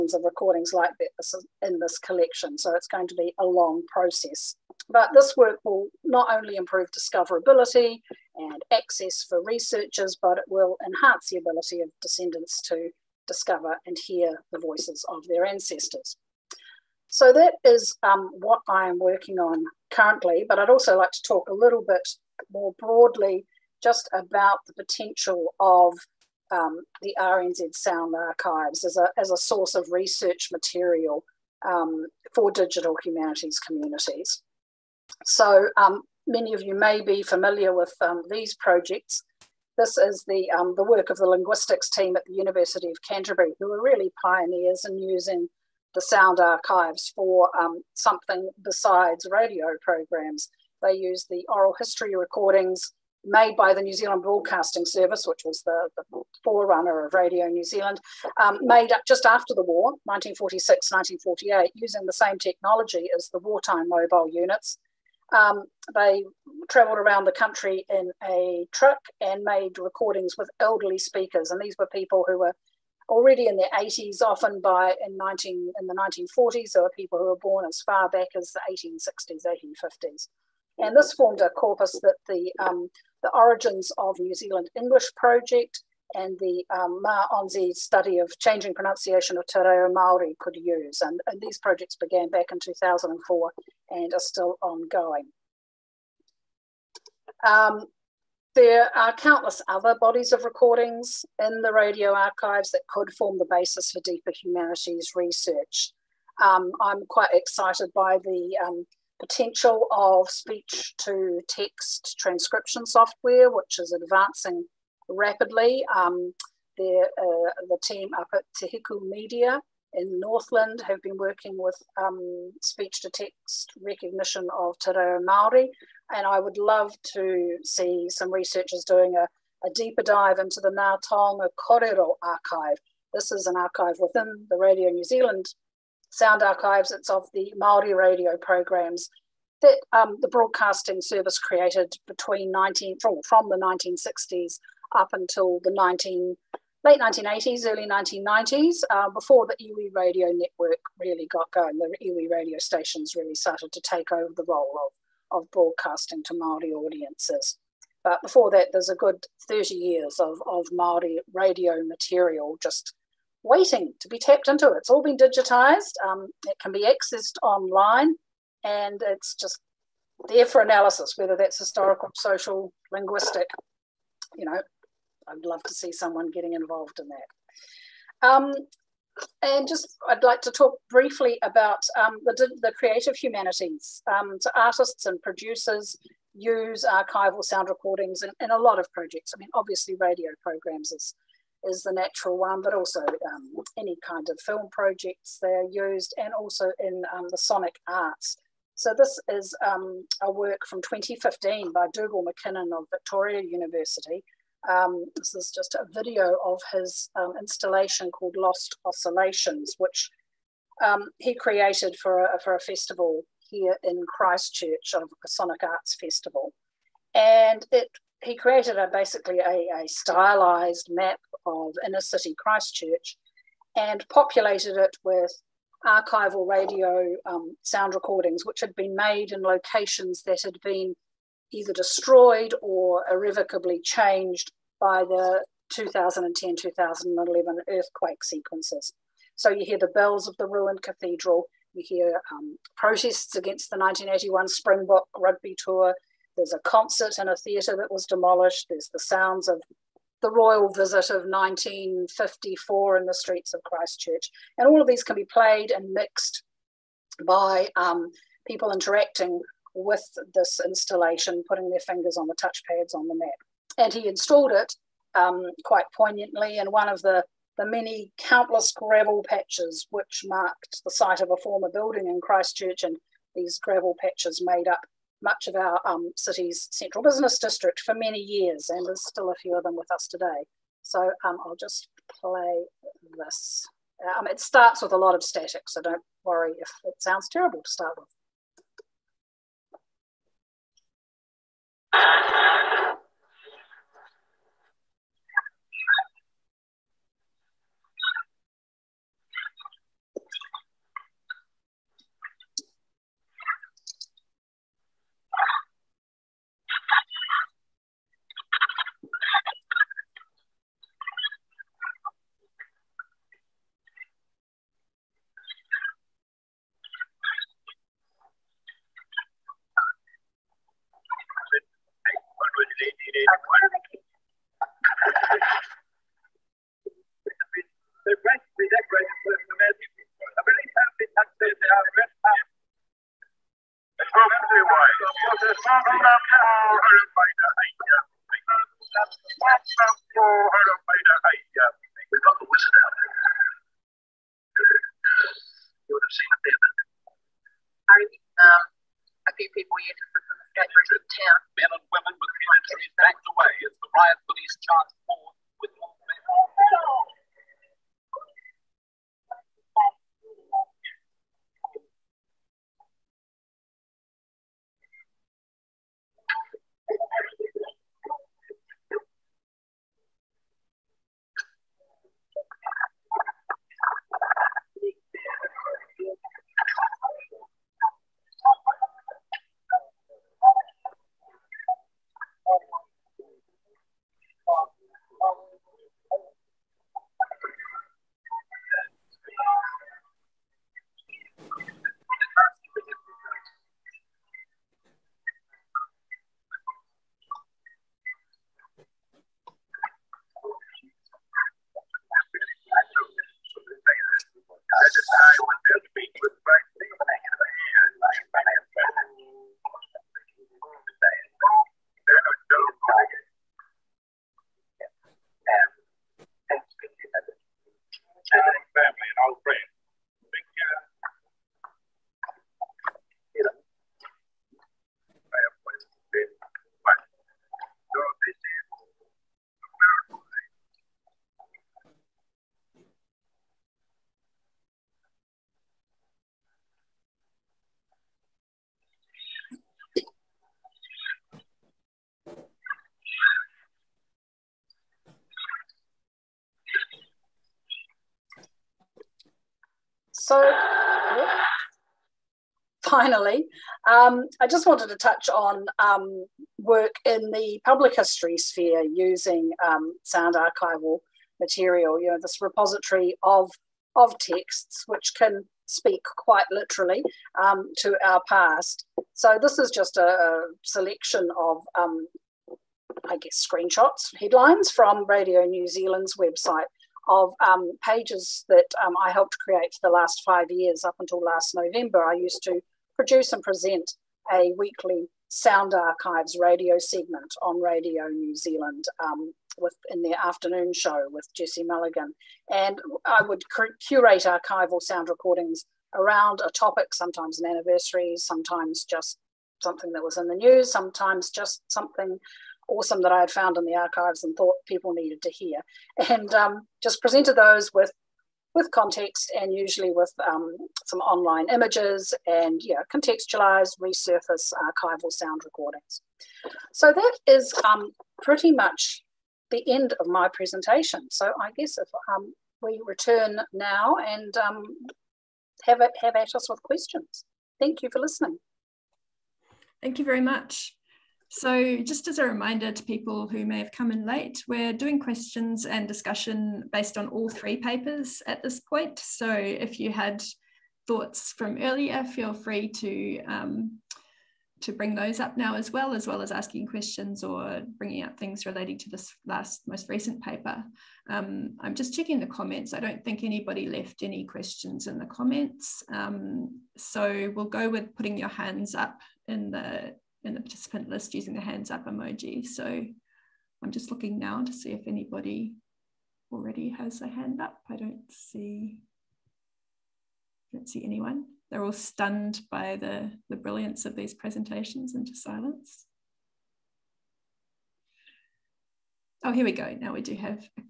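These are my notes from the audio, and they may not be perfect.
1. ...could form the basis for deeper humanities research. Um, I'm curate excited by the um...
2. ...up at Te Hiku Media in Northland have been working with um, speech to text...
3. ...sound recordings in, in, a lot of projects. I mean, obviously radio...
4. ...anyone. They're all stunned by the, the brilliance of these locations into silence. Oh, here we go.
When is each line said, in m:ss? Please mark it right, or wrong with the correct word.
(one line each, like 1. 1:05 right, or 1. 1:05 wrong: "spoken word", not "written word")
1. 1:42 wrong: "quite", not "curate"
2. 1:58 right
3. 3:07 right
4. 9:30 wrong: "presentations", not "locations".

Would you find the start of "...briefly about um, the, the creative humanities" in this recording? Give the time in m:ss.
3:00.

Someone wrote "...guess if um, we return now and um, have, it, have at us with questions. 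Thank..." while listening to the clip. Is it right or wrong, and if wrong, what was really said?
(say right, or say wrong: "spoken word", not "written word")
right.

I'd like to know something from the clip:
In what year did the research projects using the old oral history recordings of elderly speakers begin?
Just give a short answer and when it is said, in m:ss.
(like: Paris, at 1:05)
2004, at 1:32.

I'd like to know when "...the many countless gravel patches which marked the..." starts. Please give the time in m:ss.
4:27.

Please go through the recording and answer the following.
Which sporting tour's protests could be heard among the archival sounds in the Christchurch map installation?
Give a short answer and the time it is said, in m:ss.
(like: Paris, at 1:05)
1981 Springbok rugby tour, at 4:03.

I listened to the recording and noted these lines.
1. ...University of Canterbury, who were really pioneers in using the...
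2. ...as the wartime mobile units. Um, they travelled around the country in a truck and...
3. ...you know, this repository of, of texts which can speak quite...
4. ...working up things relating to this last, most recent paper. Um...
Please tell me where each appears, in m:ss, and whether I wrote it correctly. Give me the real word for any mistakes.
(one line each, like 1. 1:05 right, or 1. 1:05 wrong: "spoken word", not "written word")
1. 0:42 right
2. 1:03 right
3. 7:42 right
4. 9:07 wrong: "bringing", not "working".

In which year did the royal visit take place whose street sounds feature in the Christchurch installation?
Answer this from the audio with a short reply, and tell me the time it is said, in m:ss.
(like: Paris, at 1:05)
1954, at 4:11.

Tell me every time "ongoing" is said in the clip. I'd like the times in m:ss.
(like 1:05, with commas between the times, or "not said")
1:34.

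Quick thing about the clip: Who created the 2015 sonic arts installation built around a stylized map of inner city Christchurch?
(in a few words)
Dugal McKinnon.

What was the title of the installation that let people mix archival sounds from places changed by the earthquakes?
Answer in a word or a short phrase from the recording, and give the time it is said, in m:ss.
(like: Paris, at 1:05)
Lost Oscillations, at 3:28.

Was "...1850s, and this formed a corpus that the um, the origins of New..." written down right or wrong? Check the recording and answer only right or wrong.
right.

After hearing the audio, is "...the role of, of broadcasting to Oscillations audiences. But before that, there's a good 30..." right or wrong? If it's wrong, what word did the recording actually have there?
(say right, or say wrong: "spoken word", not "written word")
wrong: "Māori", not "Oscillations".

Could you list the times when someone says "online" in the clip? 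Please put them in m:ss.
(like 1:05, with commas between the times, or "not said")
2:47, 8:31.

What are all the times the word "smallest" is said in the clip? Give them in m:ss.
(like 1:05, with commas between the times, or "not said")
not said.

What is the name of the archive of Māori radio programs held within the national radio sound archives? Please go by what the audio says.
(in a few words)
Ngā Taonga Korero.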